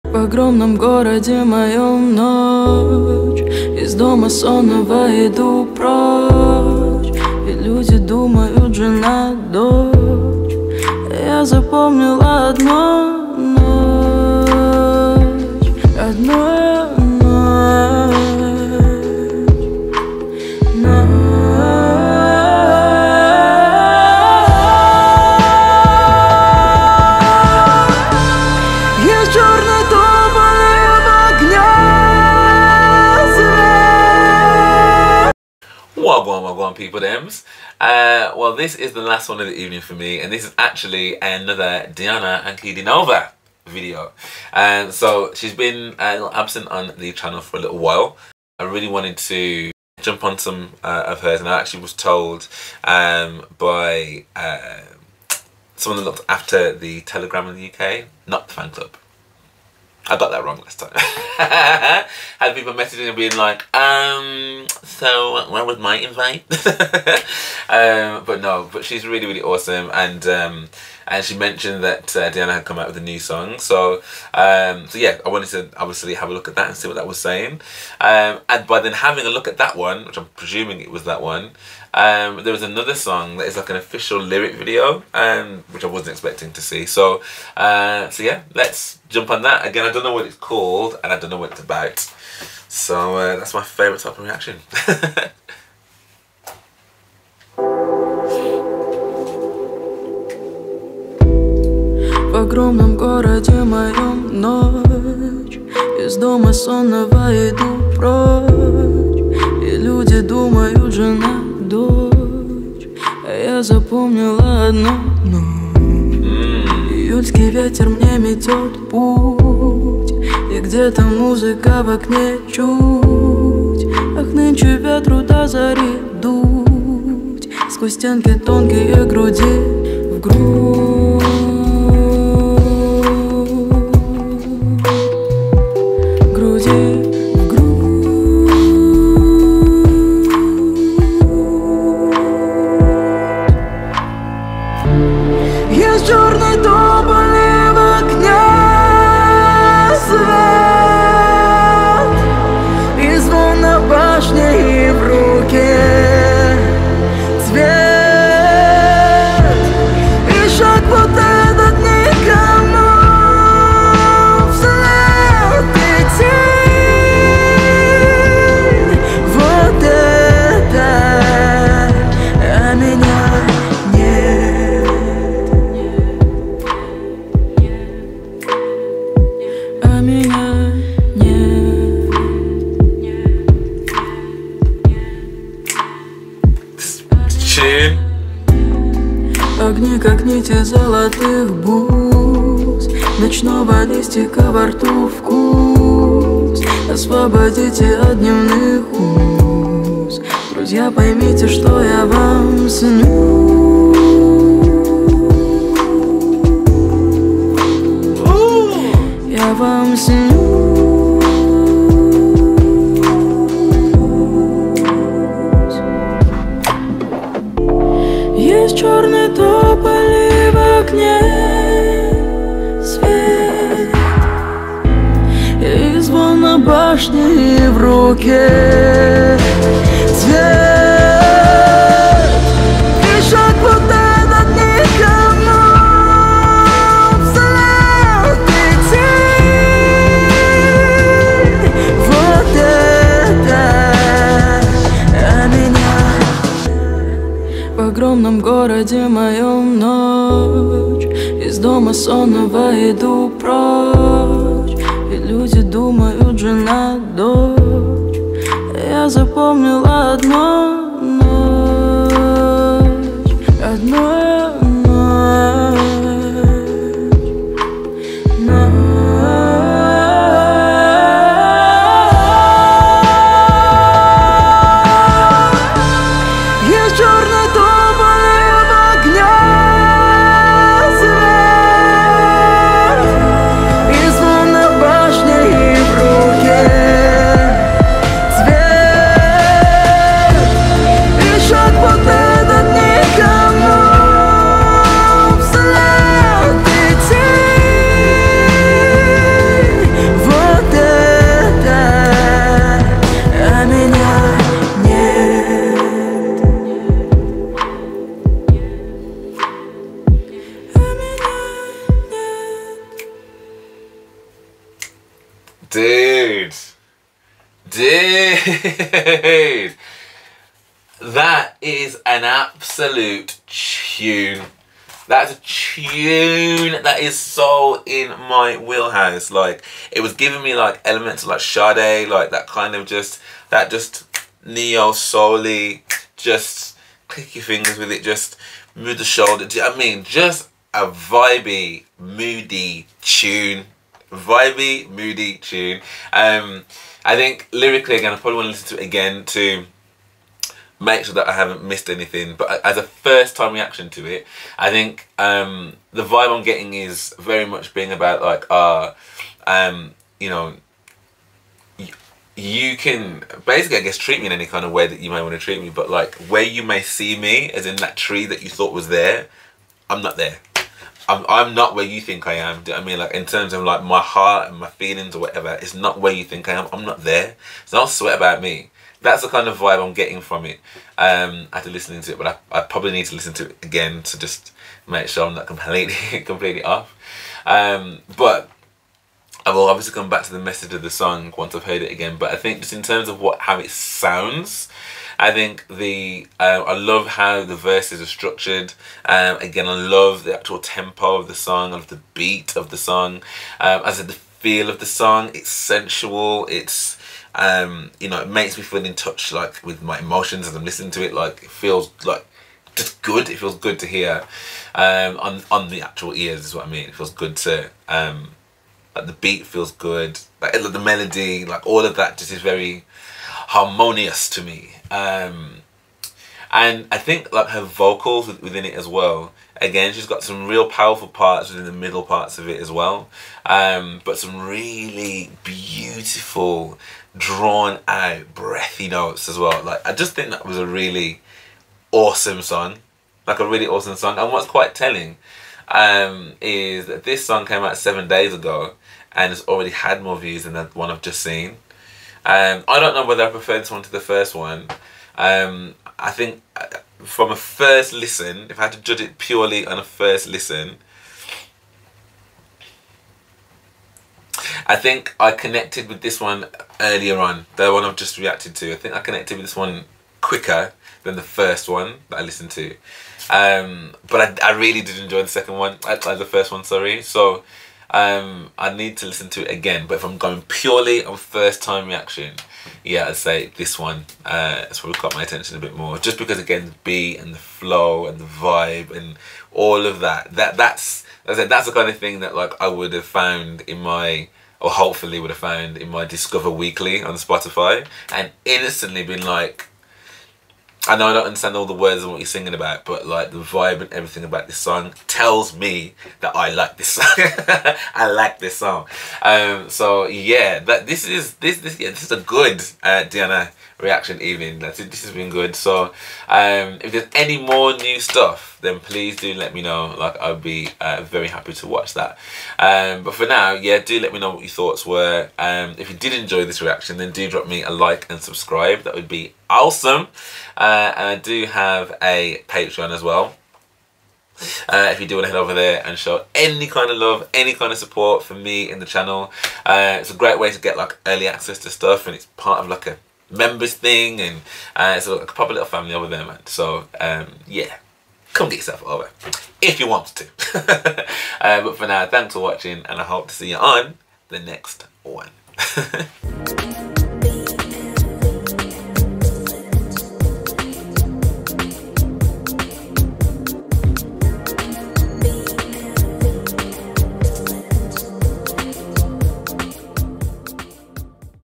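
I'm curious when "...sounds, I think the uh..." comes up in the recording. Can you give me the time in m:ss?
6:33.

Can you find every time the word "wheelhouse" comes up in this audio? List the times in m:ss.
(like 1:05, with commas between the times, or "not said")
5:28.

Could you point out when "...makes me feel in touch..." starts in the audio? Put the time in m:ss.
6:48.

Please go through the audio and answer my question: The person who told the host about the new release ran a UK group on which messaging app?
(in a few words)
Telegram.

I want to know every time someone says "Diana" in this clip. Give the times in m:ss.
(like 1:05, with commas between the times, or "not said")
0:41, 1:12, 8:33.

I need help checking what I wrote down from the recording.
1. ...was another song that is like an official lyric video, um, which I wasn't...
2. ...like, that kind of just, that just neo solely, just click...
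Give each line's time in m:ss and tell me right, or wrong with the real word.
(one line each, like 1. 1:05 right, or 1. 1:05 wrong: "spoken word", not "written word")
1. 1:22 right
2. 5:32 right.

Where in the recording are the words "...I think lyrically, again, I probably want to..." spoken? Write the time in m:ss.
5:47.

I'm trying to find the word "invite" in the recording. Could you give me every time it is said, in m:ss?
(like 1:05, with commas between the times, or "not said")
1:05.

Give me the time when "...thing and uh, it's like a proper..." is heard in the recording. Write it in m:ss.
9:03.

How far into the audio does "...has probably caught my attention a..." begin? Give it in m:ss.
8:04.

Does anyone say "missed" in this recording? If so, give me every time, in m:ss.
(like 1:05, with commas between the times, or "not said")
5:51.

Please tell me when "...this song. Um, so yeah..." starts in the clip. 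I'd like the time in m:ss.
8:28.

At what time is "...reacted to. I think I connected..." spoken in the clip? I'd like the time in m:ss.
7:48.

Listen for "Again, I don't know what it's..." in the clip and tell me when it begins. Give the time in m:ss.
1:29.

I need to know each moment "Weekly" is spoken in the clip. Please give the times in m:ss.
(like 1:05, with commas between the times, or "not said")
8:16.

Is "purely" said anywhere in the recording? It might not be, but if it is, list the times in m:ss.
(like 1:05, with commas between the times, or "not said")
7:39, 8:00.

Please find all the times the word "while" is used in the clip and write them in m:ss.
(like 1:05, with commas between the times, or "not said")
0:47.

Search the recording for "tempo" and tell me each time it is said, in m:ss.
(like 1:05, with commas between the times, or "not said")
6:40.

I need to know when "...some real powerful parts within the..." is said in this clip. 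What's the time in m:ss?
7:10.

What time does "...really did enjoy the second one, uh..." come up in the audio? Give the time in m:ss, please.
7:54.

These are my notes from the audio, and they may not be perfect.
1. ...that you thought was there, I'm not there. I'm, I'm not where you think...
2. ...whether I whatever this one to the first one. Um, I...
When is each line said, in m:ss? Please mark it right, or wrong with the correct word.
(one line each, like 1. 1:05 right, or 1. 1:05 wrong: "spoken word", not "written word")
1. 6:08 right
2. 7:33 wrong: "prefer", not "whatever".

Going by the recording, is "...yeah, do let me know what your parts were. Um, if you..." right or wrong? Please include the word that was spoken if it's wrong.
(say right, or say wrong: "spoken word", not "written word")
wrong: "thoughts", not "parts".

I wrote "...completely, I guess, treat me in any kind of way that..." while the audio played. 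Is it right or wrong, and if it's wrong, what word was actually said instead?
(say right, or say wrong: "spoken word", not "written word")
wrong: "basically", not "completely".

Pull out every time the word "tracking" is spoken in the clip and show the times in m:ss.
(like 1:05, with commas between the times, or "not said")
not said.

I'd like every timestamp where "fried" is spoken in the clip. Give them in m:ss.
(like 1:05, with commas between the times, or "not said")
not said.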